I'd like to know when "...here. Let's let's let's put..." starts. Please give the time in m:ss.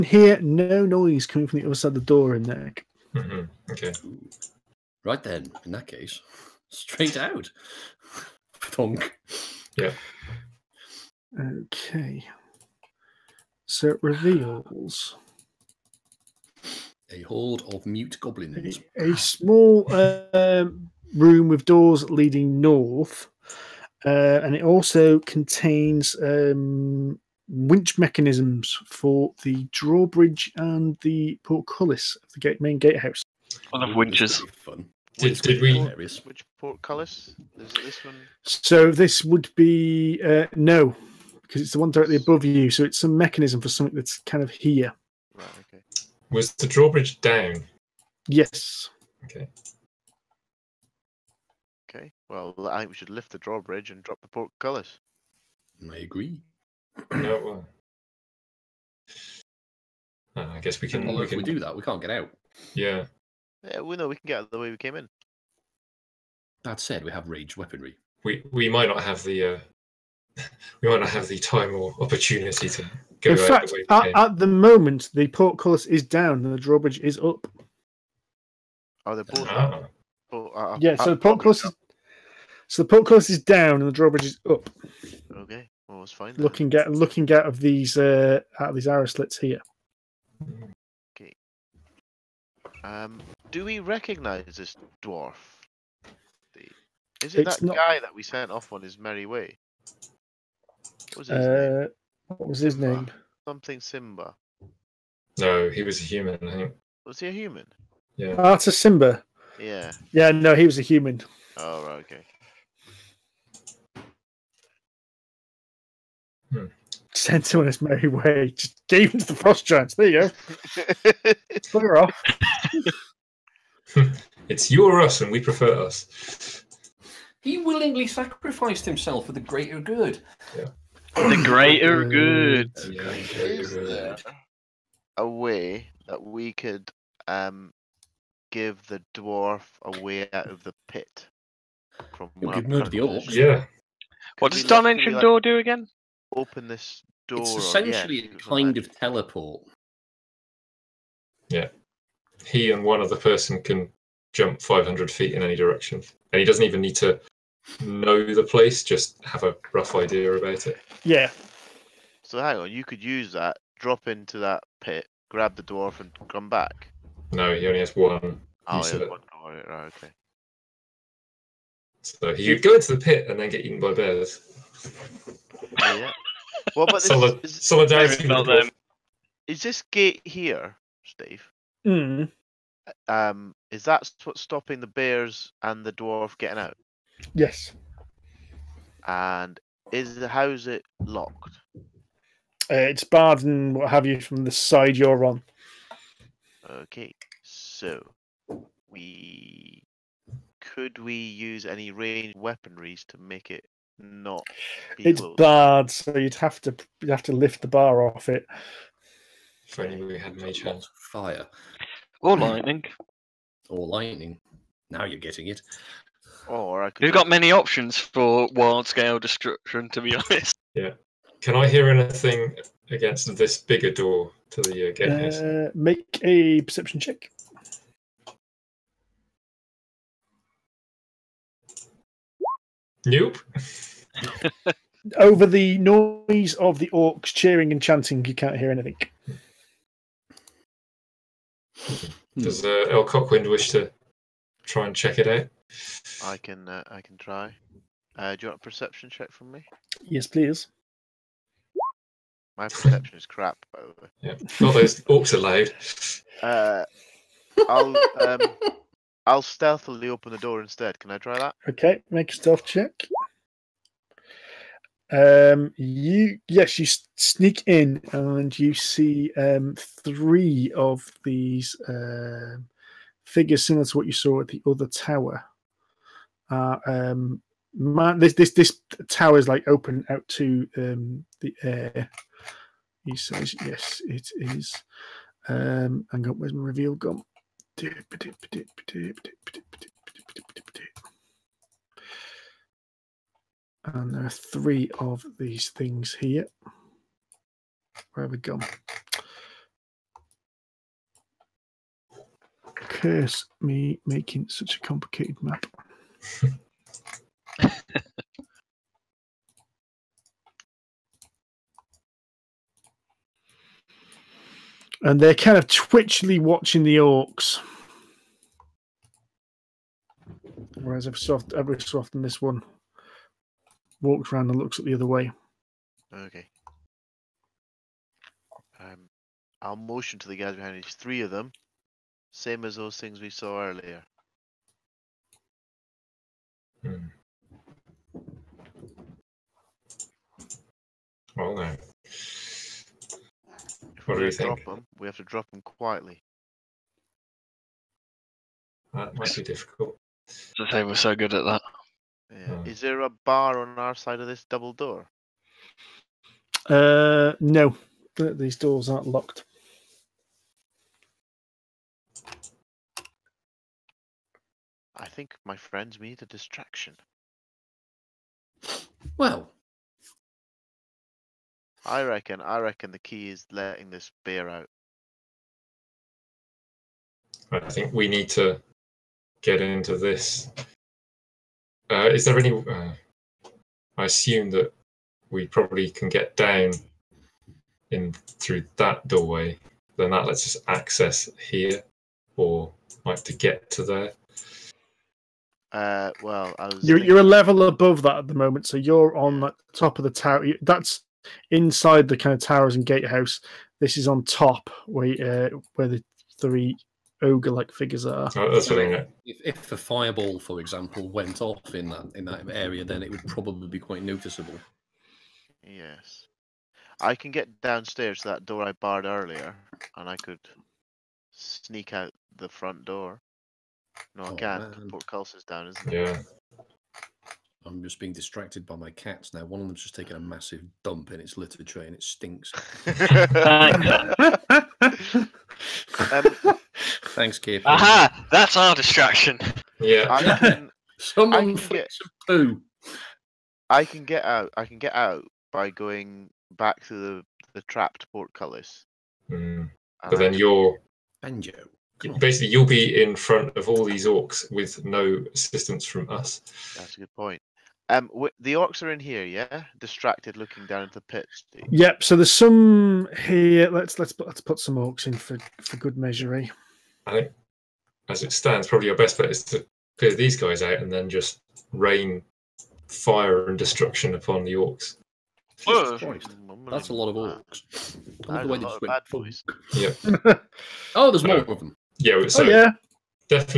7:43.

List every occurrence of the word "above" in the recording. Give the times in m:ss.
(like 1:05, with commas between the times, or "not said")
0:42, 6:37.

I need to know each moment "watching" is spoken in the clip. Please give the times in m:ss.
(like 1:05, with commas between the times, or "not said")
5:16.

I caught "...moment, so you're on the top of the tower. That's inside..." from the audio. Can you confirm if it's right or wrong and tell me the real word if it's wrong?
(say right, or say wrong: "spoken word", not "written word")
right.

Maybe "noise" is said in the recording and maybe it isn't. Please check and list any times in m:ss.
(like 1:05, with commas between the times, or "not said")
0:00, 3:55.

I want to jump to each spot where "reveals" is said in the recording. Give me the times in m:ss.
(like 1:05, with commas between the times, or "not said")
0:14, 4:46.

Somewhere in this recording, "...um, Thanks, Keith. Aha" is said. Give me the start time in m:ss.
7:16.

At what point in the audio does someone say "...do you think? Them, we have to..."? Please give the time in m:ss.
5:44.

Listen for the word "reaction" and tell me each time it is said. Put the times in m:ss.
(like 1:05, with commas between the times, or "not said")
not said.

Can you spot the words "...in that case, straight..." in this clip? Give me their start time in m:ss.
0:05.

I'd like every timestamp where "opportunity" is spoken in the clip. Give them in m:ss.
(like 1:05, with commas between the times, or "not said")
1:12.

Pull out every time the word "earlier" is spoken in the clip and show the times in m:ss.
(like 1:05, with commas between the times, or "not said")
5:33, 6:59.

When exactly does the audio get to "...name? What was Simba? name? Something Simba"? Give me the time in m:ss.
1:41.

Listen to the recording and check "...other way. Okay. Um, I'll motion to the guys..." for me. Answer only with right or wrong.
right.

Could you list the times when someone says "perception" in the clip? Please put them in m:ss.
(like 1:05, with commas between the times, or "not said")
3:46, 4:08, 4:12.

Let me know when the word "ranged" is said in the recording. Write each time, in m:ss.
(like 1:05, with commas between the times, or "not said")
1:07, 3:21.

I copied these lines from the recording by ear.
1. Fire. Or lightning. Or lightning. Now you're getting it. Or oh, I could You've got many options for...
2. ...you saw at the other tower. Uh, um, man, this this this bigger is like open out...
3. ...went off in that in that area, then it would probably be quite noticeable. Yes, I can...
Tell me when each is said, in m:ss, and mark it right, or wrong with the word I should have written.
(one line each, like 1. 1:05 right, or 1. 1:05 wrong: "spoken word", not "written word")
1. 3:30 right
2. 4:34 wrong: "tower", not "bigger"
3. 6:51 right.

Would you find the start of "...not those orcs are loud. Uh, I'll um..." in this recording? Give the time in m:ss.
4:14.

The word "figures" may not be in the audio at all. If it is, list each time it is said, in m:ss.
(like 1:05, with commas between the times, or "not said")
4:33, 6:47.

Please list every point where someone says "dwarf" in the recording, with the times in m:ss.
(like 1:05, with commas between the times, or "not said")
1:35, 2:19, 2:45, 3:05.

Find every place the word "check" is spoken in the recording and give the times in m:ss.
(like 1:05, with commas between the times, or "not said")
3:47, 4:04, 4:09, 4:22.